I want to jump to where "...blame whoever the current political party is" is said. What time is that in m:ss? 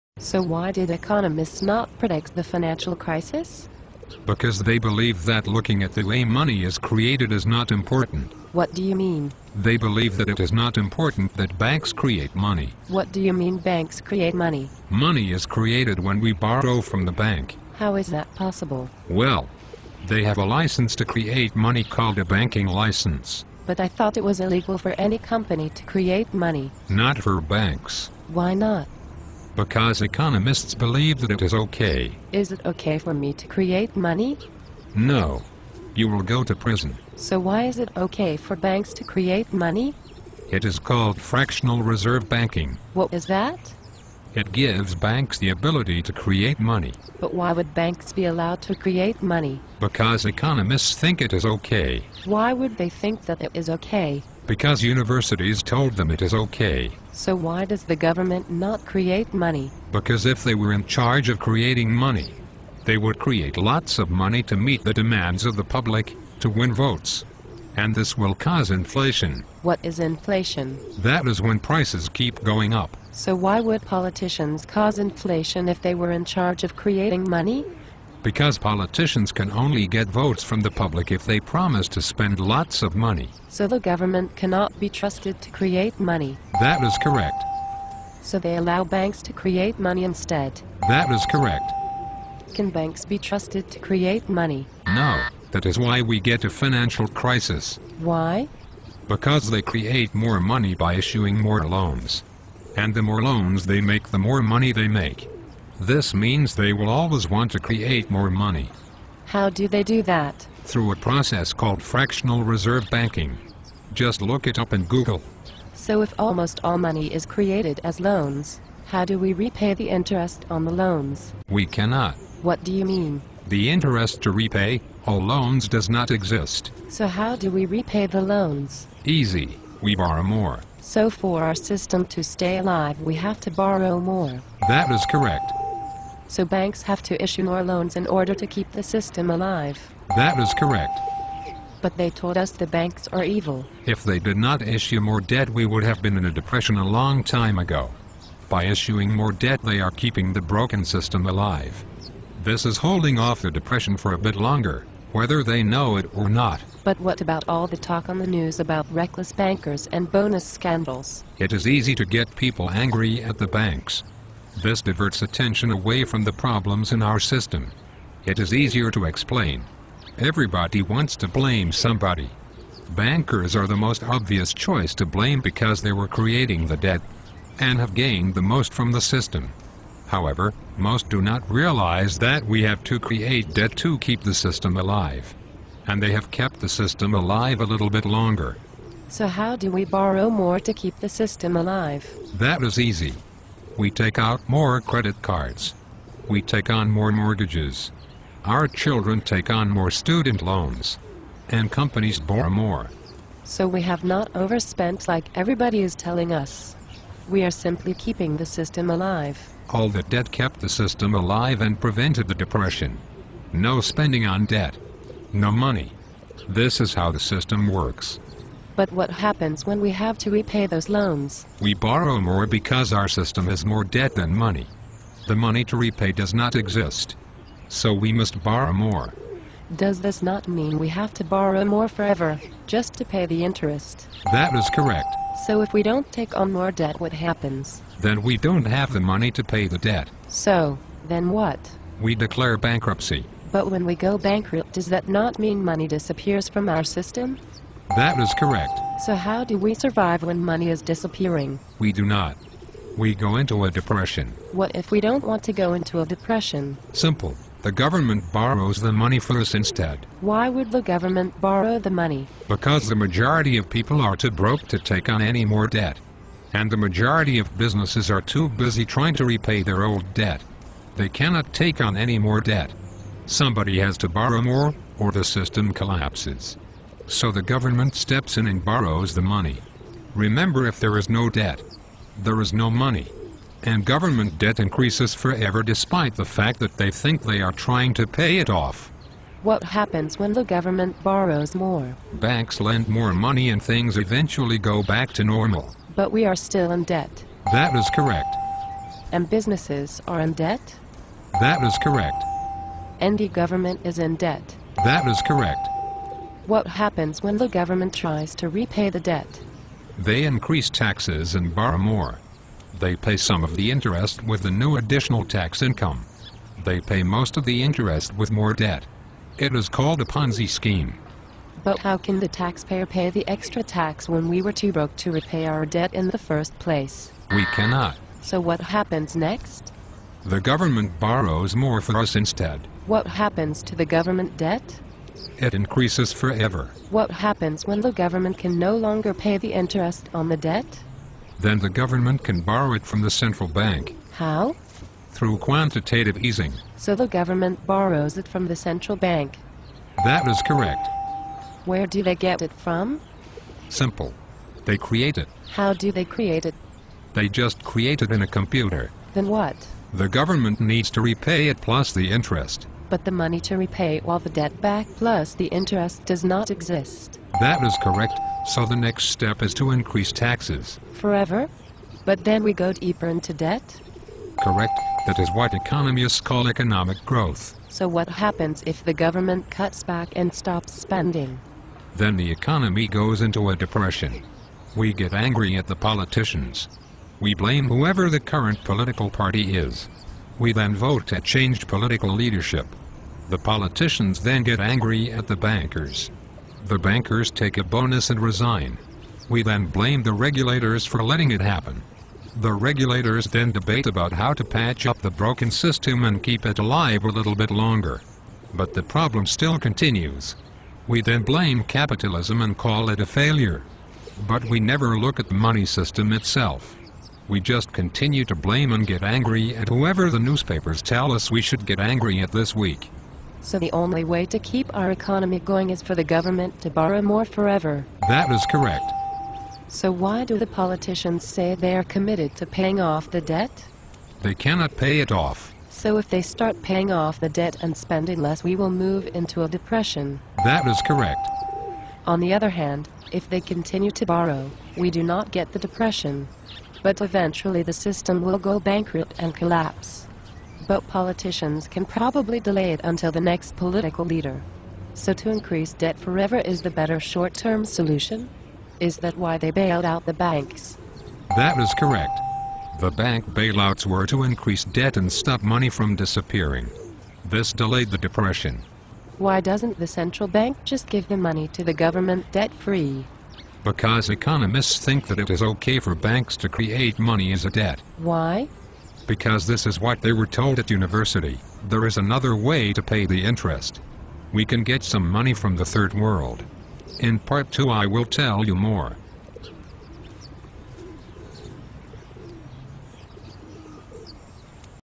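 6:27.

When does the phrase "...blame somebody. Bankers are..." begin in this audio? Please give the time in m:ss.
2:51.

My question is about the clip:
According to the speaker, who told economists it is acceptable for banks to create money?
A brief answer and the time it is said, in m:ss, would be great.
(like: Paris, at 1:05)
universities, at 0:54.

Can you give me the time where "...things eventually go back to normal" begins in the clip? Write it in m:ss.
4:53.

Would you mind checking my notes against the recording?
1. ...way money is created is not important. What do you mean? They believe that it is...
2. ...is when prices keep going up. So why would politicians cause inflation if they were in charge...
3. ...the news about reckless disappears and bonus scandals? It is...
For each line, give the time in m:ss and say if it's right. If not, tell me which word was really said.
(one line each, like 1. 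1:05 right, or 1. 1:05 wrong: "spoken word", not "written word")
1. 0:06 right
2. 1:11 right
3. 2:38 wrong: "bankers", not "disappears".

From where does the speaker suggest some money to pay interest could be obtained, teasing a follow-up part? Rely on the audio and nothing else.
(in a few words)
the third world.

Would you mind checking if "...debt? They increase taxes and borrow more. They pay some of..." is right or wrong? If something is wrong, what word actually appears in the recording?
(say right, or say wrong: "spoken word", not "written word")
right.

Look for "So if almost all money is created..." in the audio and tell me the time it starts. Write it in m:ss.
1:55.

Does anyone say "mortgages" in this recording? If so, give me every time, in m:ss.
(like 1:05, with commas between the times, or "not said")
3:17.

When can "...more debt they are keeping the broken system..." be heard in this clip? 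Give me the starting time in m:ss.
2:29.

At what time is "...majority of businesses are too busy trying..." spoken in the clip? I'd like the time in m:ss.
4:26.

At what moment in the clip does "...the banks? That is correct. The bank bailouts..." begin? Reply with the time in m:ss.
7:40.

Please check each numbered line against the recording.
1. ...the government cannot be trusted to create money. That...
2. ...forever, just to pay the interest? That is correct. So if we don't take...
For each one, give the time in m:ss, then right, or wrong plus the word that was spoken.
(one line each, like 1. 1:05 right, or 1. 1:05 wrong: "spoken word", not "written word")
1. 1:23 right
2. 3:51 right.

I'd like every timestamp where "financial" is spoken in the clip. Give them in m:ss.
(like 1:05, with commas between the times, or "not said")
0:02, 1:36.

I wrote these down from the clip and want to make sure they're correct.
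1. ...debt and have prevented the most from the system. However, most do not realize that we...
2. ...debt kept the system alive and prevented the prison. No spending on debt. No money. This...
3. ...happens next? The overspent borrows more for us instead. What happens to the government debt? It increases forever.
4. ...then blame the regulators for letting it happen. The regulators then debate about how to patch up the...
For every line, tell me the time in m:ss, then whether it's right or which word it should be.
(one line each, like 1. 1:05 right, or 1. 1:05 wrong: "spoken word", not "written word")
1. 2:56 wrong: "gained", not "prevented"
2. 3:30 wrong: "depression", not "prison"
3. 5:28 wrong: "government", not "overspent"
4. 6:39 right.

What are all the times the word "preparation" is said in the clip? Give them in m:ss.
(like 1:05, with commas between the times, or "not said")
not said.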